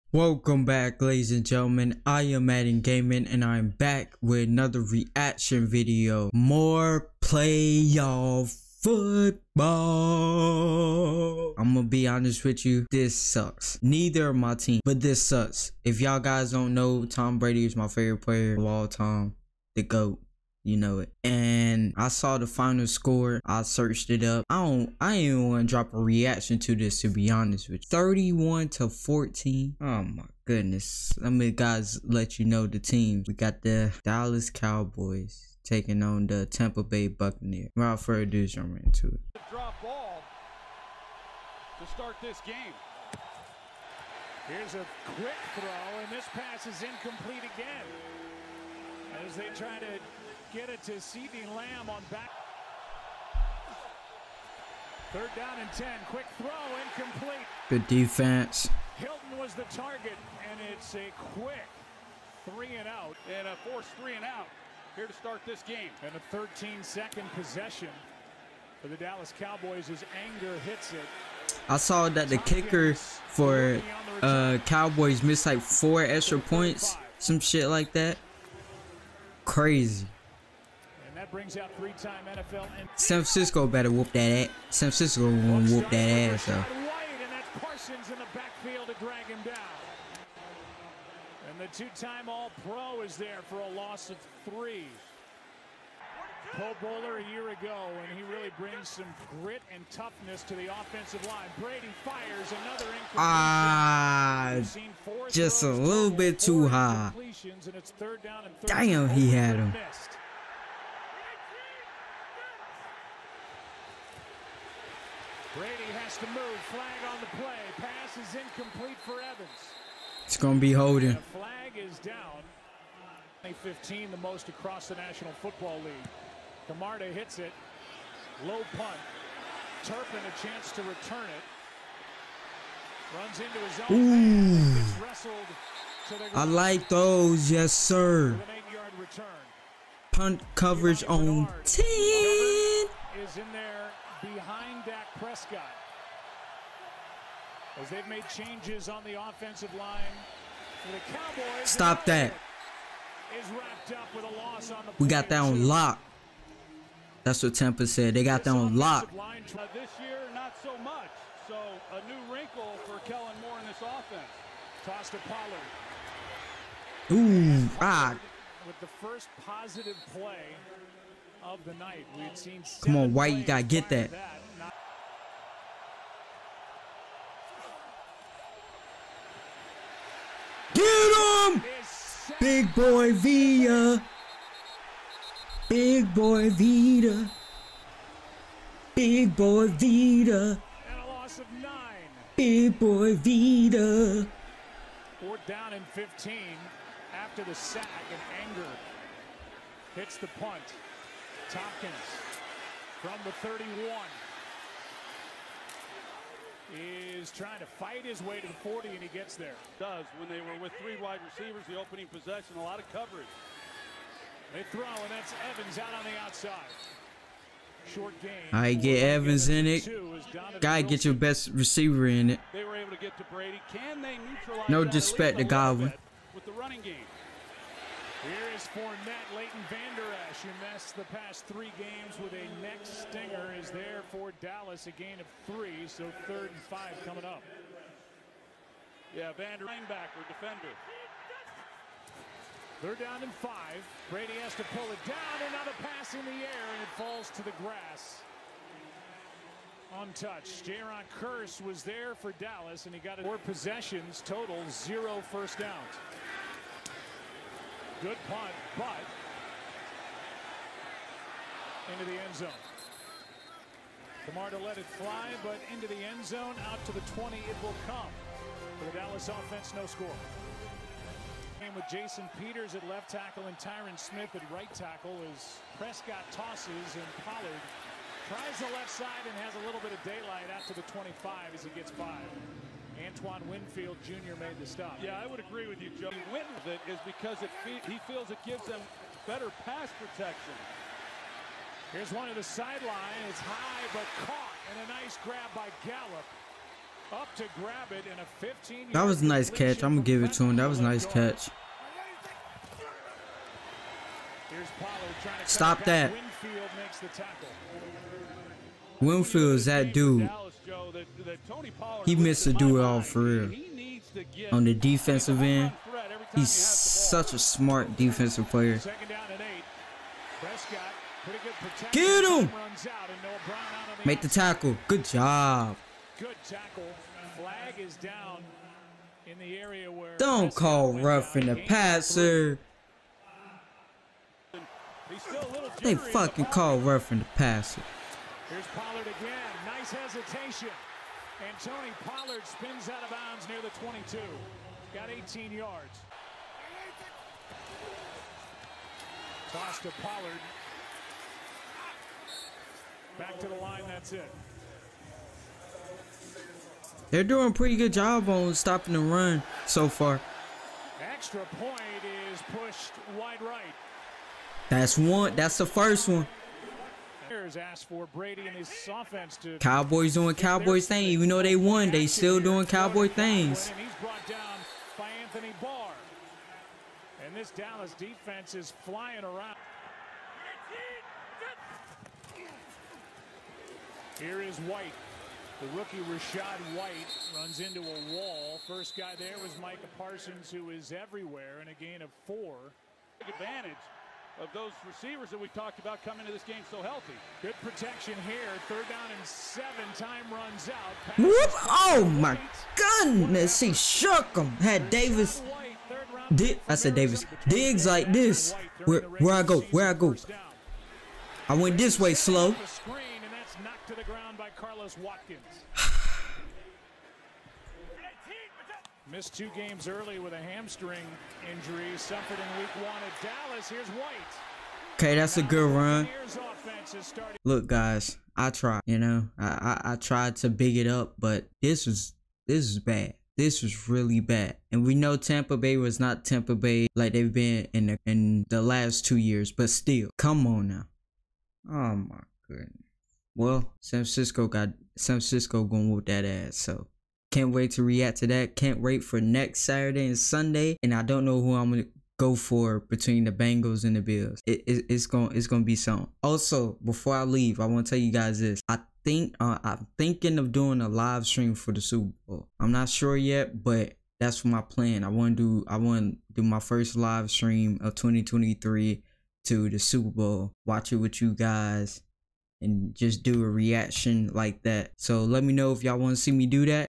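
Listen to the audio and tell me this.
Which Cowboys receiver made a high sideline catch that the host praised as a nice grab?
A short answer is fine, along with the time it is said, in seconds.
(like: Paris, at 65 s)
Gallup, at 295 s.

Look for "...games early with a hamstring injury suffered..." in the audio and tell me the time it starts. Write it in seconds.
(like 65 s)
419 s.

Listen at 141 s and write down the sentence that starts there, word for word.
Is in there behind Dak Prescott.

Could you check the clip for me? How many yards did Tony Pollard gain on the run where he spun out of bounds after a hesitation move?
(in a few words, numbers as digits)
18.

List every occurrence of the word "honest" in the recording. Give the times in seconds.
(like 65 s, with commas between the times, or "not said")
12 s, 27 s.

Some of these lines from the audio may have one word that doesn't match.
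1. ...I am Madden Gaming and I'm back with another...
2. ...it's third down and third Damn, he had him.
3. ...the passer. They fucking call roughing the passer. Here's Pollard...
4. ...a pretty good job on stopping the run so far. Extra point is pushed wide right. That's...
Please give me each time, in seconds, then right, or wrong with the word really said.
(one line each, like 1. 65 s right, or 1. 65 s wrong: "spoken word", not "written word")
1. 2 s right
2. 107 s right
3. 331 s right
4. 357 s right.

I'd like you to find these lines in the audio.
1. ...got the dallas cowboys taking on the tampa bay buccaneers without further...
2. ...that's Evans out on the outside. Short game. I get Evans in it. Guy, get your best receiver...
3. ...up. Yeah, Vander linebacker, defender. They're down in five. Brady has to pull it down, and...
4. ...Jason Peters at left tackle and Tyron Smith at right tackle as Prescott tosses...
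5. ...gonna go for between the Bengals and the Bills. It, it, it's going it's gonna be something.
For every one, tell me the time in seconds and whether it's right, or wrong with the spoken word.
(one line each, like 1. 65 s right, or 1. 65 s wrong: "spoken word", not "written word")
1. 33 s right
2. 215 s right
3. 237 s right
4. 271 s right
5. 451 s right.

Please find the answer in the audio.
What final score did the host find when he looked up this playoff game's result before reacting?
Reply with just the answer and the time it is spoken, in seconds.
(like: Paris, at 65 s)
31 to 14, at 27 s.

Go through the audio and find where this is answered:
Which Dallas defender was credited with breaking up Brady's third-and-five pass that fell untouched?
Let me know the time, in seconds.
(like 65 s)
250 s.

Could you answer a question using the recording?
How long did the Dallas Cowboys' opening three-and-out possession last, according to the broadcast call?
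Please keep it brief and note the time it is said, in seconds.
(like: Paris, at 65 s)
13 seconds, at 66 s.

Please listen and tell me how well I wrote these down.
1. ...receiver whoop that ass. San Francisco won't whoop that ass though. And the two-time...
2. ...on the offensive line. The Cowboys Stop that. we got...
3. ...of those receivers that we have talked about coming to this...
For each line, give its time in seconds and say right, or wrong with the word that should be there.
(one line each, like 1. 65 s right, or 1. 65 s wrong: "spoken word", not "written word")
1. 83 s wrong: "better", not "receiver"
2. 148 s right
3. 394 s right.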